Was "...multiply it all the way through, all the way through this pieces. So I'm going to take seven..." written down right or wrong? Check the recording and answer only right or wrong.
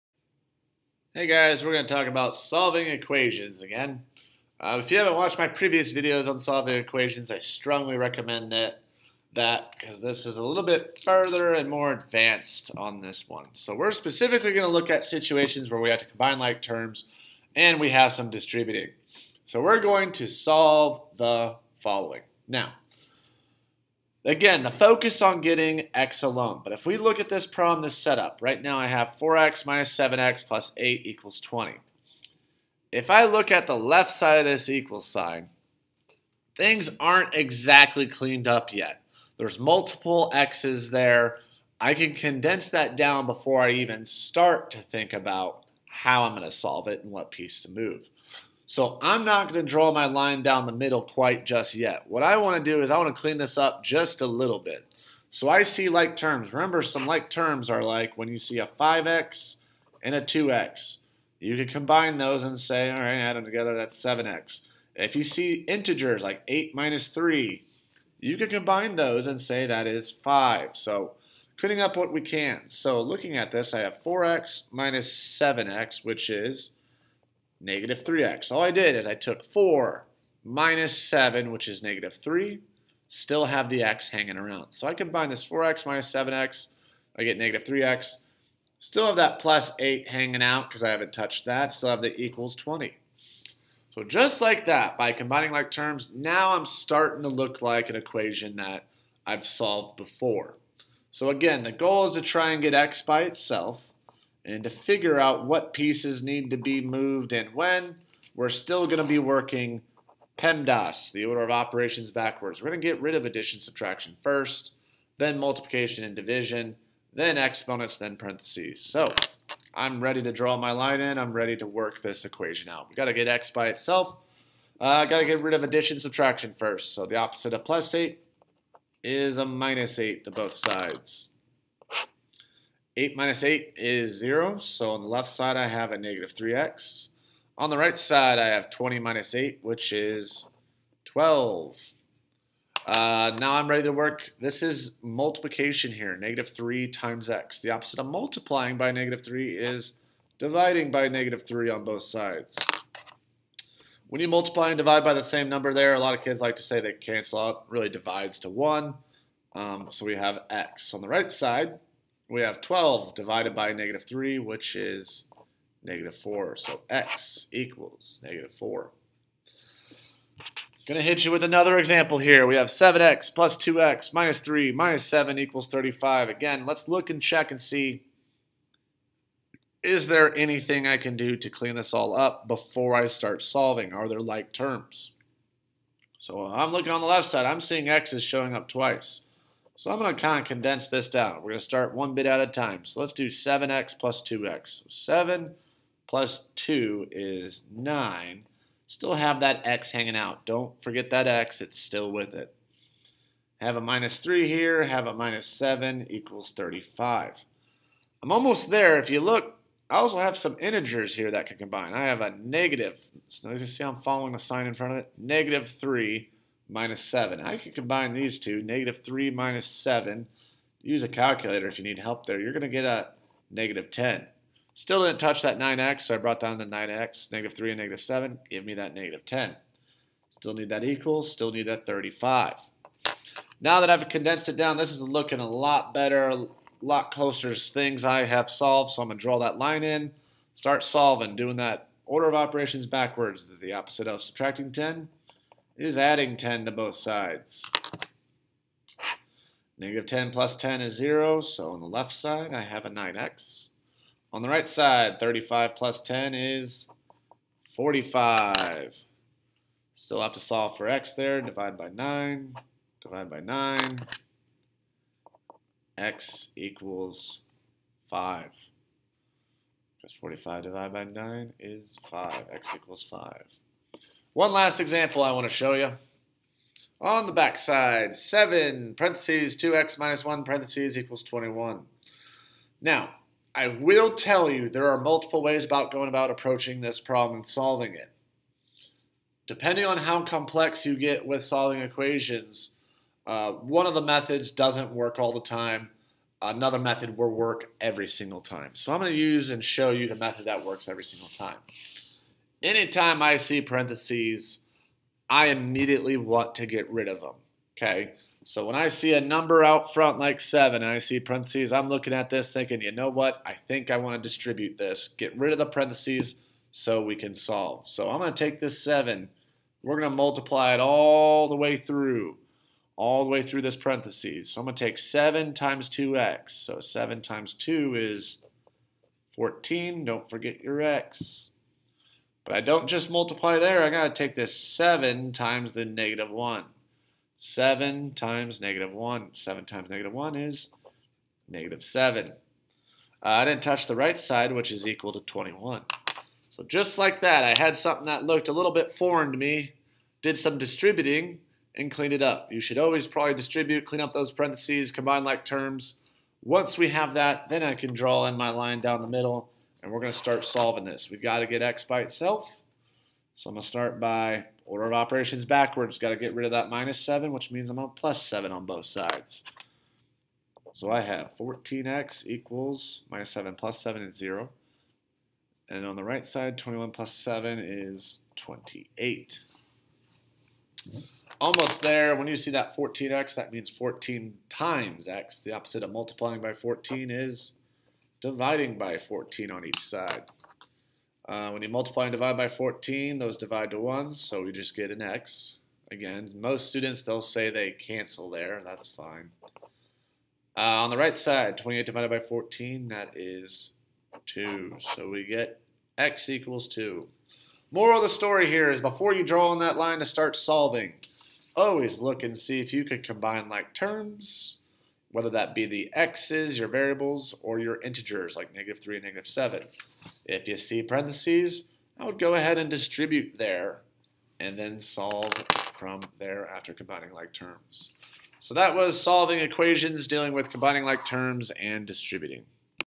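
wrong.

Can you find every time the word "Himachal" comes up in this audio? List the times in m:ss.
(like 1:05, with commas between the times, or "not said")
not said.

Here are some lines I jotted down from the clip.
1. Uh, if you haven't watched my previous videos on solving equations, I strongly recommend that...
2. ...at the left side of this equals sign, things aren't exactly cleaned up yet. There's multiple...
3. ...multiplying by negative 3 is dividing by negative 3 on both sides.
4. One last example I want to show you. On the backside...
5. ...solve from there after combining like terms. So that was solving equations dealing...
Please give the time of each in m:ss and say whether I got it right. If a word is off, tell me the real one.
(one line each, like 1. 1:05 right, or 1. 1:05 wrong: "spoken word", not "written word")
1. 0:04 right
2. 0:33 right
3. 2:28 right
4. 4:34 right
5. 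7:04 right.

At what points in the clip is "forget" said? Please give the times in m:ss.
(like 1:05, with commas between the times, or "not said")
3:20, 5:30.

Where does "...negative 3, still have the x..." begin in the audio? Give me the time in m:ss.
1:21.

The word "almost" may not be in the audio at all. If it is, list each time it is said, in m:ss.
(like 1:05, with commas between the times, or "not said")
3:28, 6:21.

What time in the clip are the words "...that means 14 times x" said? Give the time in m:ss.
6:23.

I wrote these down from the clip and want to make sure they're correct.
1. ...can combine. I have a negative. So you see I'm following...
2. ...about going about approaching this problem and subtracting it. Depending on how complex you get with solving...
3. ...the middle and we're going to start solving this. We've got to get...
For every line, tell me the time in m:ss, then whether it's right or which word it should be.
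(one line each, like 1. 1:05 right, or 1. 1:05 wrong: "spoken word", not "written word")
1. 3:31 right
2. 4:45 wrong: "solving", not "subtracting"
3. 5:59 right.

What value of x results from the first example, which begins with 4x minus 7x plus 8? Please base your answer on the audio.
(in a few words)
-4.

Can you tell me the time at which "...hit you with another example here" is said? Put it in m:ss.
2:51.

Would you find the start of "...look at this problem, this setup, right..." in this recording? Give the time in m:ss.
0:26.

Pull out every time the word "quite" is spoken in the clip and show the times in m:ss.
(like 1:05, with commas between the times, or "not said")
0:51.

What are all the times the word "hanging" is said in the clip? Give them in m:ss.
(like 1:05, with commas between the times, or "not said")
1:24, 1:30, 3:19.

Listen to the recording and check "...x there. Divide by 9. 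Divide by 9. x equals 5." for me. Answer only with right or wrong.
right.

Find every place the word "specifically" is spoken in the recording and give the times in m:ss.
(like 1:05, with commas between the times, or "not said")
0:13.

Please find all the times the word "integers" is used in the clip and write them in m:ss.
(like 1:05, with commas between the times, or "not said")
1:05, 3:30, 6:57.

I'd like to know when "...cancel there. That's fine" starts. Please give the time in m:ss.
6:37.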